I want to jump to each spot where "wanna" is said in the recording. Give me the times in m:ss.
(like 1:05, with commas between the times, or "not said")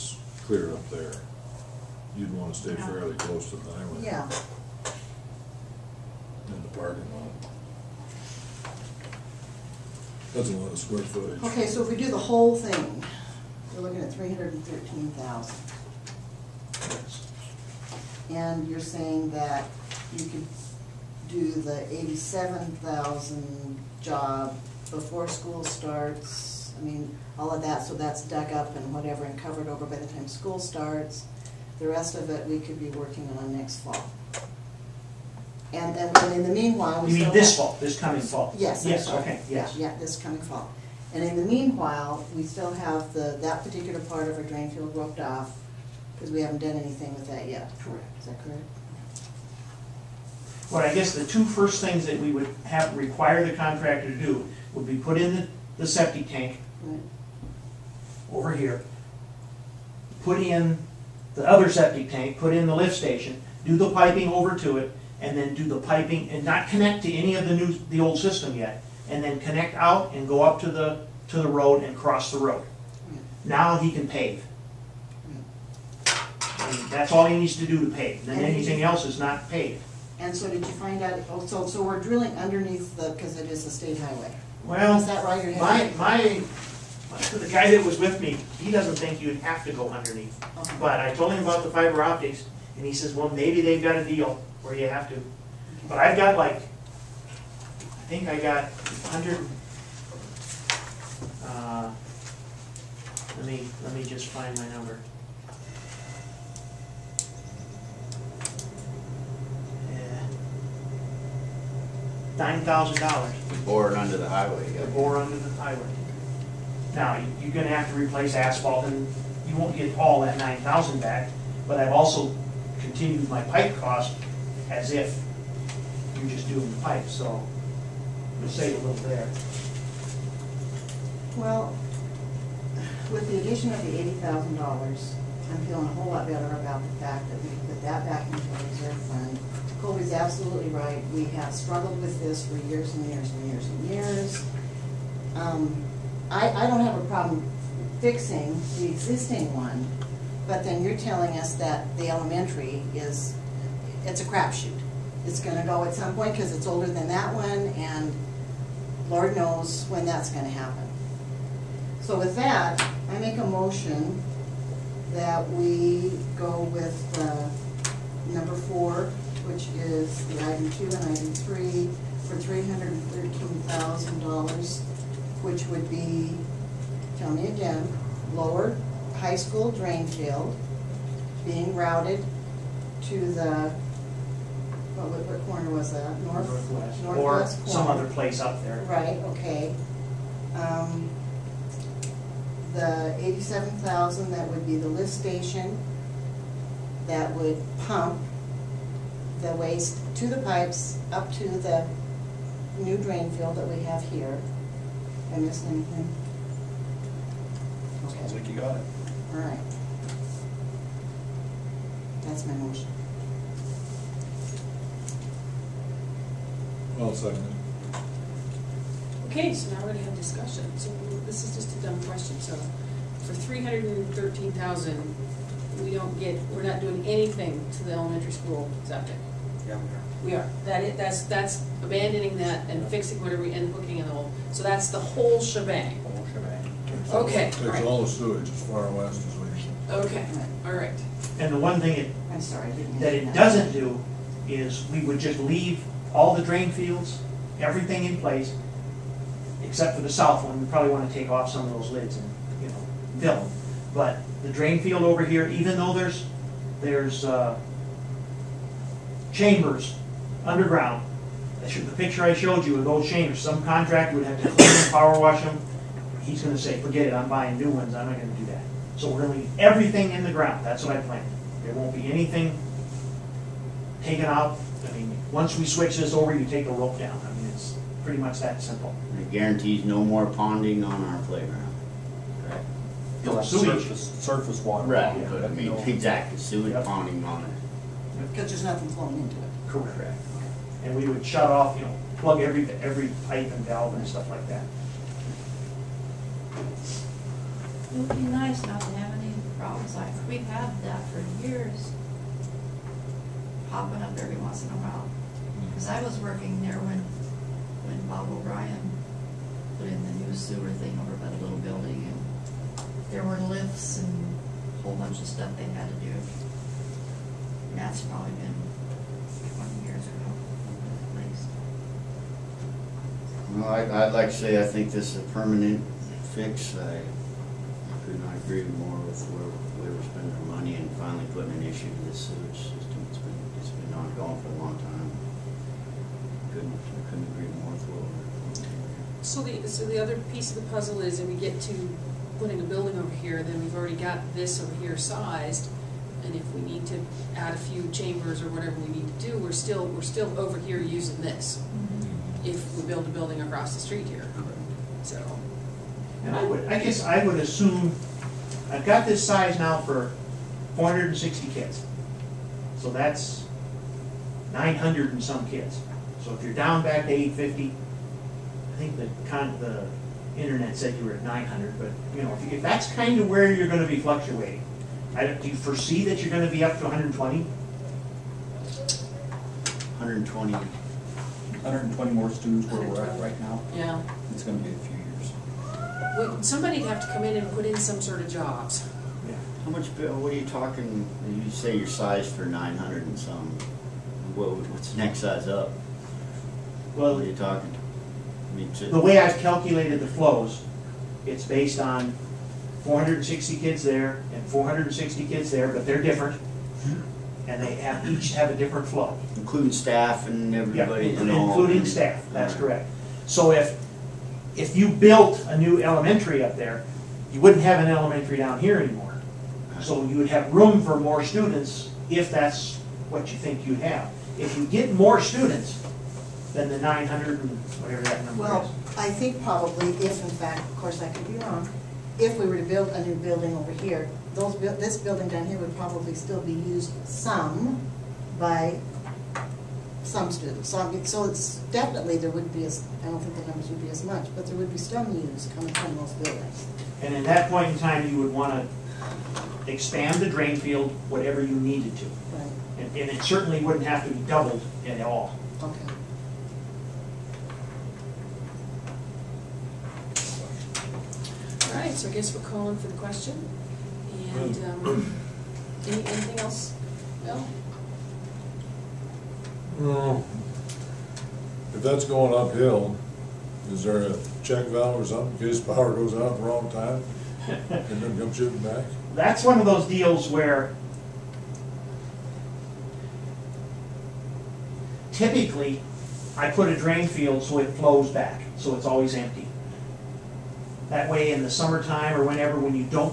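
0:02, 7:28.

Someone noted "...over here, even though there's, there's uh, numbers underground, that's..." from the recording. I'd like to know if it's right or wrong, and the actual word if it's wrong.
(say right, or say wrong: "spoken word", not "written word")
wrong: "chambers", not "numbers".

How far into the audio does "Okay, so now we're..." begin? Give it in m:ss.
3:39.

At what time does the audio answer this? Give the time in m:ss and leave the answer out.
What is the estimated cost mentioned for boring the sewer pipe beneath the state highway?
1:52.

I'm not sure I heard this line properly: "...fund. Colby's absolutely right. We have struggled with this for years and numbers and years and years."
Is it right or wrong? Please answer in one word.
wrong.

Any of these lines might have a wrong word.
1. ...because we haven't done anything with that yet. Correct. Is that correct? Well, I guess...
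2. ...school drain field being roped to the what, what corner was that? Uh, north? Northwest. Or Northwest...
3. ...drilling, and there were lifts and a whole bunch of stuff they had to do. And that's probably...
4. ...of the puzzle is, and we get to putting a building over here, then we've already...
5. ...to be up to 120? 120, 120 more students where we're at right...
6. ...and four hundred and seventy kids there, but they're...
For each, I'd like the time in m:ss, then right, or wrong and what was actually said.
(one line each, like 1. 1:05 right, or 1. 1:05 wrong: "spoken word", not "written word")
1. 0:46 right
2. 2:59 wrong: "routed", not "roped"
3. 5:11 wrong: "building", not "drilling"
4. 5:40 right
5. 6:16 right
6. 6:44 wrong: "sixty", not "seventy".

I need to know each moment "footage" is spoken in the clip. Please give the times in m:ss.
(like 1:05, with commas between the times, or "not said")
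0:11.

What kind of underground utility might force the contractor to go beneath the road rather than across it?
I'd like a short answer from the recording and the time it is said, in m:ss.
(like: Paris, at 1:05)
fiber optics, at 1:31.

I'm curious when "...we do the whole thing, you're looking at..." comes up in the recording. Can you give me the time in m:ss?
0:11.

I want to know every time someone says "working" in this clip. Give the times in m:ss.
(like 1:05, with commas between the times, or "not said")
0:32, 5:06.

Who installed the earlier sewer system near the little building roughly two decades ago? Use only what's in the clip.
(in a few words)
Bob O'Brien.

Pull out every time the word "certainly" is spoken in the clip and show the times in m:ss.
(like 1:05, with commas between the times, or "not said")
7:33.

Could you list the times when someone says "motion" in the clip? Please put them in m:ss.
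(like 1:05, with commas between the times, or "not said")
2:43, 3:32.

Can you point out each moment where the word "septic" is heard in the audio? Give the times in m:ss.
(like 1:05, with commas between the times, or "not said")
0:55, 1:01, 3:48.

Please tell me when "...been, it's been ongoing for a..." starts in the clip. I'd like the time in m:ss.
5:33.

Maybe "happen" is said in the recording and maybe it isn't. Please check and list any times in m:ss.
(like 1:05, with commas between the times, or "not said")
2:40.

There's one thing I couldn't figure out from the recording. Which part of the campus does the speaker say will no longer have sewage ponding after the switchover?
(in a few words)
playground.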